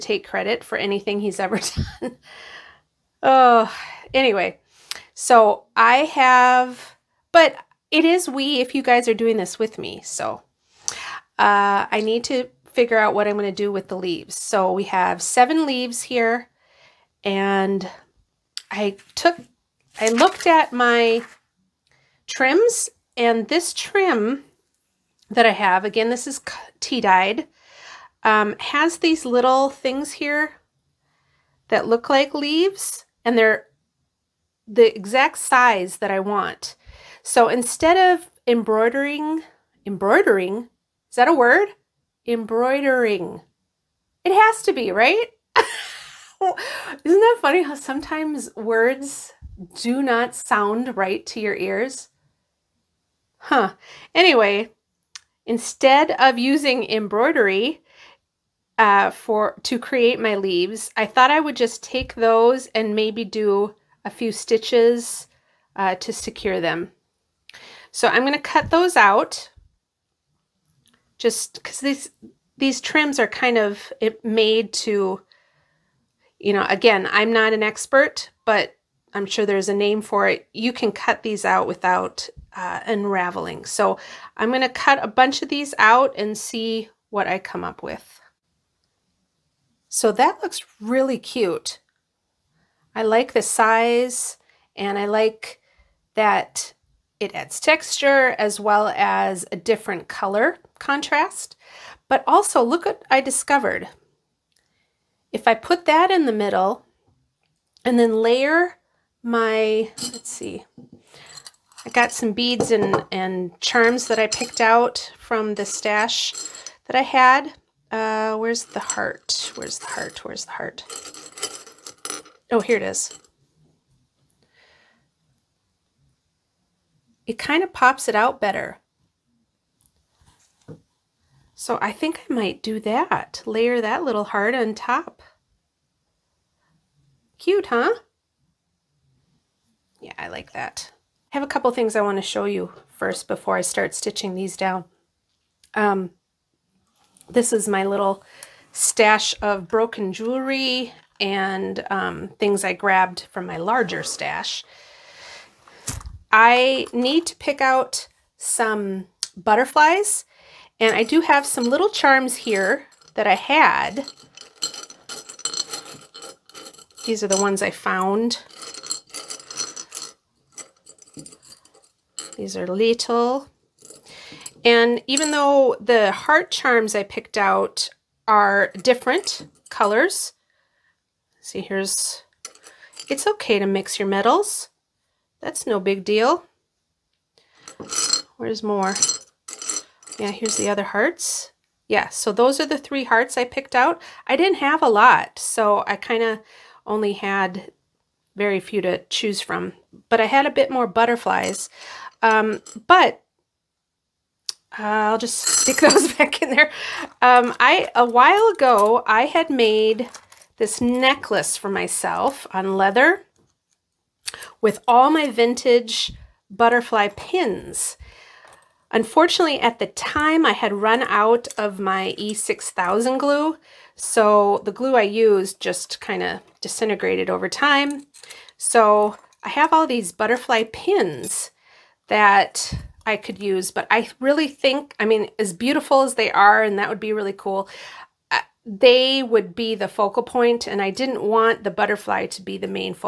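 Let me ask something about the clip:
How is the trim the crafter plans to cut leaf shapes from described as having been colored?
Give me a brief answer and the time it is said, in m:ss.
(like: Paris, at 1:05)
tea dyed, at 0:26.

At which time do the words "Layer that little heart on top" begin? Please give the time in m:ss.
2:13.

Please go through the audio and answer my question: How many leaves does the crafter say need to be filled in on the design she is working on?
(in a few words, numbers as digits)
7.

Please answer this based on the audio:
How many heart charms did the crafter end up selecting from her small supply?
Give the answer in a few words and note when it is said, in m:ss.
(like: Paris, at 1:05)
3, at 3:12.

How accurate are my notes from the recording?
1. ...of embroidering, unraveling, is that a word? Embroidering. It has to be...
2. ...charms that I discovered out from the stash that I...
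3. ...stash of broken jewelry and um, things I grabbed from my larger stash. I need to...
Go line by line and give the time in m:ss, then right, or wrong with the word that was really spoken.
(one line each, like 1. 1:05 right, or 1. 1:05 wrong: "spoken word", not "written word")
1. 0:38 wrong: "embroidering", not "unraveling"
2. 1:53 wrong: "picked", not "discovered"
3. 2:28 right.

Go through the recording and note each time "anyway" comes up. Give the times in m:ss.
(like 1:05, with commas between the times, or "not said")
0:04, 0:54.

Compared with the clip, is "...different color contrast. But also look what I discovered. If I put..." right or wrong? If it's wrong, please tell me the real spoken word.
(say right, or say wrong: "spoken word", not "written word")
right.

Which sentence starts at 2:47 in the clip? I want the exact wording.
These are the ones I found.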